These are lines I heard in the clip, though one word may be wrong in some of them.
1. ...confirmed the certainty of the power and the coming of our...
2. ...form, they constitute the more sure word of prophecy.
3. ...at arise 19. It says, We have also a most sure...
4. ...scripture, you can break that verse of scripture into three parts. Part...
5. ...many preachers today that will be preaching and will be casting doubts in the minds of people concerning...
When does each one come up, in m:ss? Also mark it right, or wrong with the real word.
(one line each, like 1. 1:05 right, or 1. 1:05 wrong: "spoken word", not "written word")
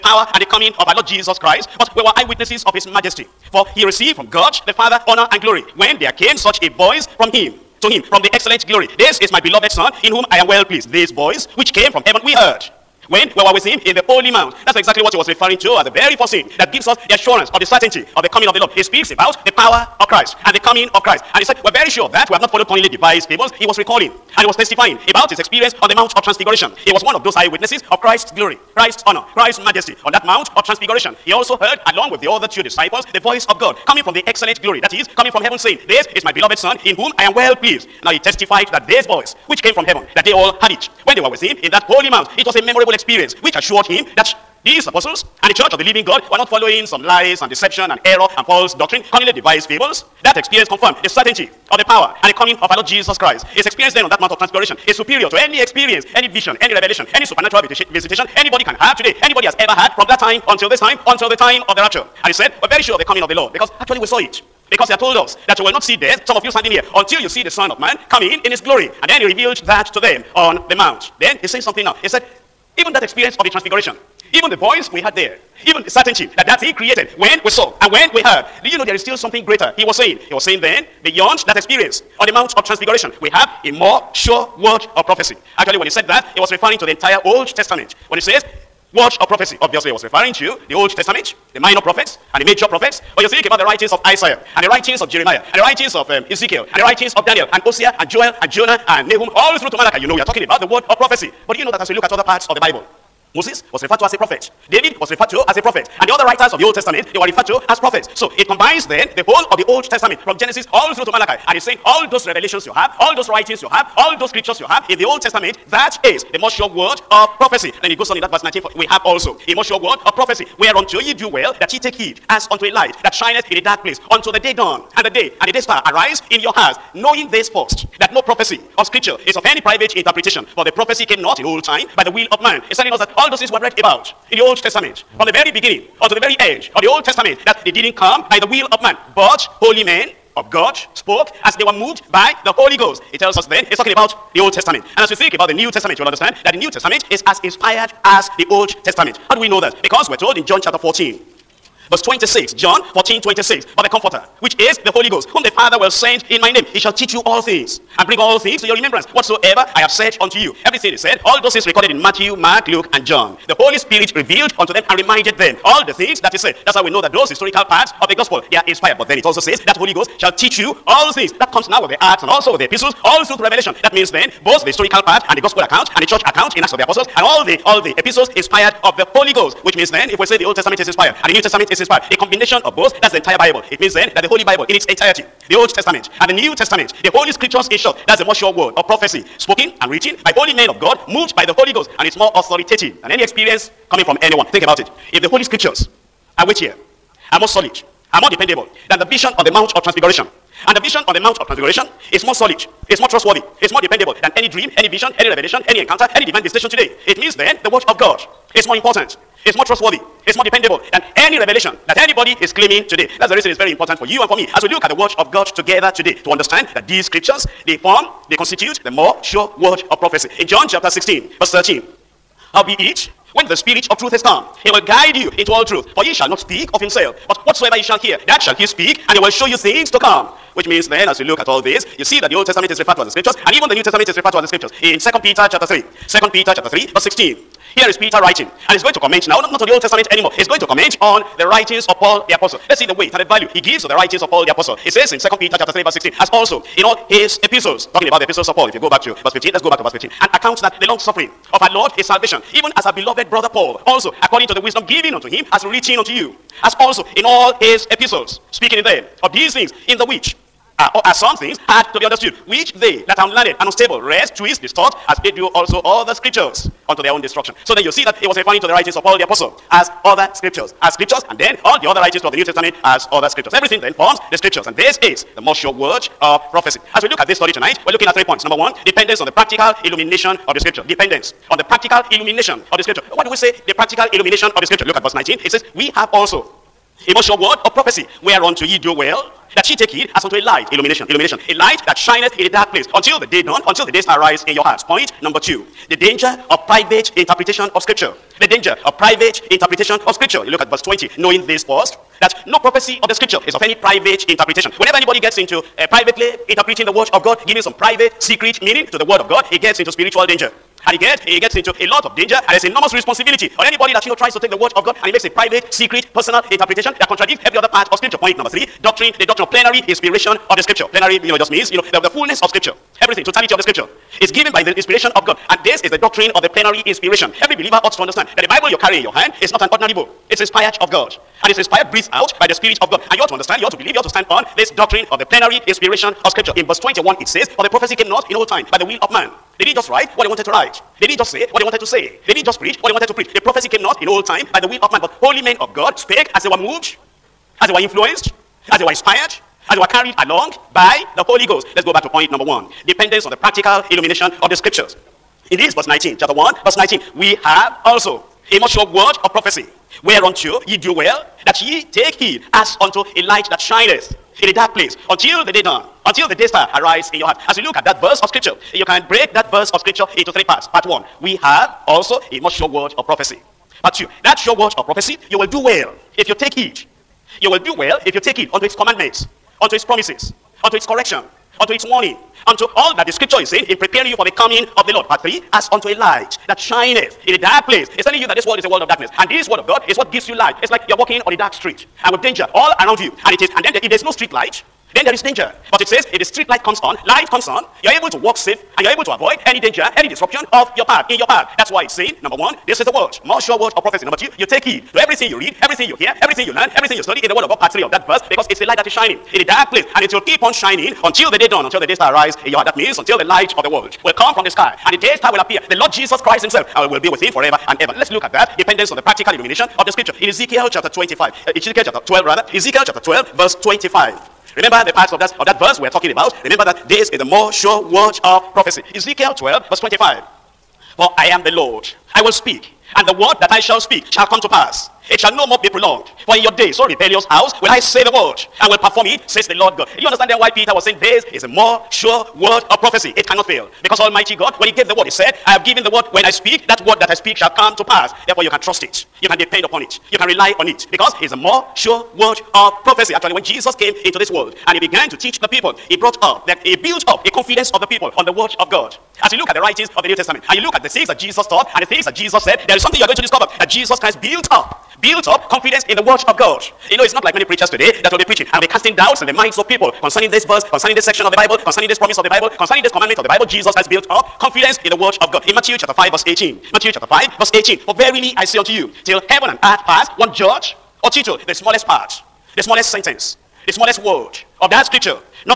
1. 0:50 right
2. 3:37 right
3. 4:44 wrong: "verse", not "arise"
4. 6:08 right
5. 7:47 right.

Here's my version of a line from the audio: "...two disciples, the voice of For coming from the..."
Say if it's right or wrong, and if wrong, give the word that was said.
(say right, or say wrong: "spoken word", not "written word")
wrong: "God", not "For".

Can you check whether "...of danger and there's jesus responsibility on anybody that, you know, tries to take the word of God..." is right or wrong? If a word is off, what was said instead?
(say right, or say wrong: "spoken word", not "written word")
wrong: "enormous", not "jesus".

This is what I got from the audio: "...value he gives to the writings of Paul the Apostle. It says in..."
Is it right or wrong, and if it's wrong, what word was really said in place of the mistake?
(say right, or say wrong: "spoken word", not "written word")
right.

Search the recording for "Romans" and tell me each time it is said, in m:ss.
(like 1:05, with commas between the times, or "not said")
not said.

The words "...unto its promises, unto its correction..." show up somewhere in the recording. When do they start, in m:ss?
6:19.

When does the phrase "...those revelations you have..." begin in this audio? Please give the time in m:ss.
1:52.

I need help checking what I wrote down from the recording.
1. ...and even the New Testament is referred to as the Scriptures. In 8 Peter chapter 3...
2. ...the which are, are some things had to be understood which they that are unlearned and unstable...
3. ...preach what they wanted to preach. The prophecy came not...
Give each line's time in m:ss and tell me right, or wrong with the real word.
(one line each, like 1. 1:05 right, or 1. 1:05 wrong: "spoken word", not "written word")
1. 3:53 wrong: "2", not "8"
2. 4:19 right
3. 5:42 right.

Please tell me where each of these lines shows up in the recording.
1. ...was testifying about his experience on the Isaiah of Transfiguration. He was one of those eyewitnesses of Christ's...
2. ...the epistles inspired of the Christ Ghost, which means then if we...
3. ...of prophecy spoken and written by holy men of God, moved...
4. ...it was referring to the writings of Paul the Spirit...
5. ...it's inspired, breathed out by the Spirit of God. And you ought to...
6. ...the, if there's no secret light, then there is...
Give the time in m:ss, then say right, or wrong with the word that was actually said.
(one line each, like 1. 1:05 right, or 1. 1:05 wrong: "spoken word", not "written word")
1. 0:24 wrong: "Mount", not "Isaiah"
2. 2:57 wrong: "Holy", not "Christ"
3. 3:08 right
4. 4:28 wrong: "Apostle", not "Spirit"
5. 5:31 right
6. 6:33 wrong: "street", not "secret".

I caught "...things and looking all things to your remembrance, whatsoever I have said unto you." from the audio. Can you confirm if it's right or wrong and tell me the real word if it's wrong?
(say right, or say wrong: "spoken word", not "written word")
wrong: "bring", not "looking".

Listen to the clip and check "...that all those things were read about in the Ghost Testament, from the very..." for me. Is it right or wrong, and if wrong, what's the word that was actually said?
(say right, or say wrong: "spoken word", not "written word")
wrong: "Old", not "Ghost".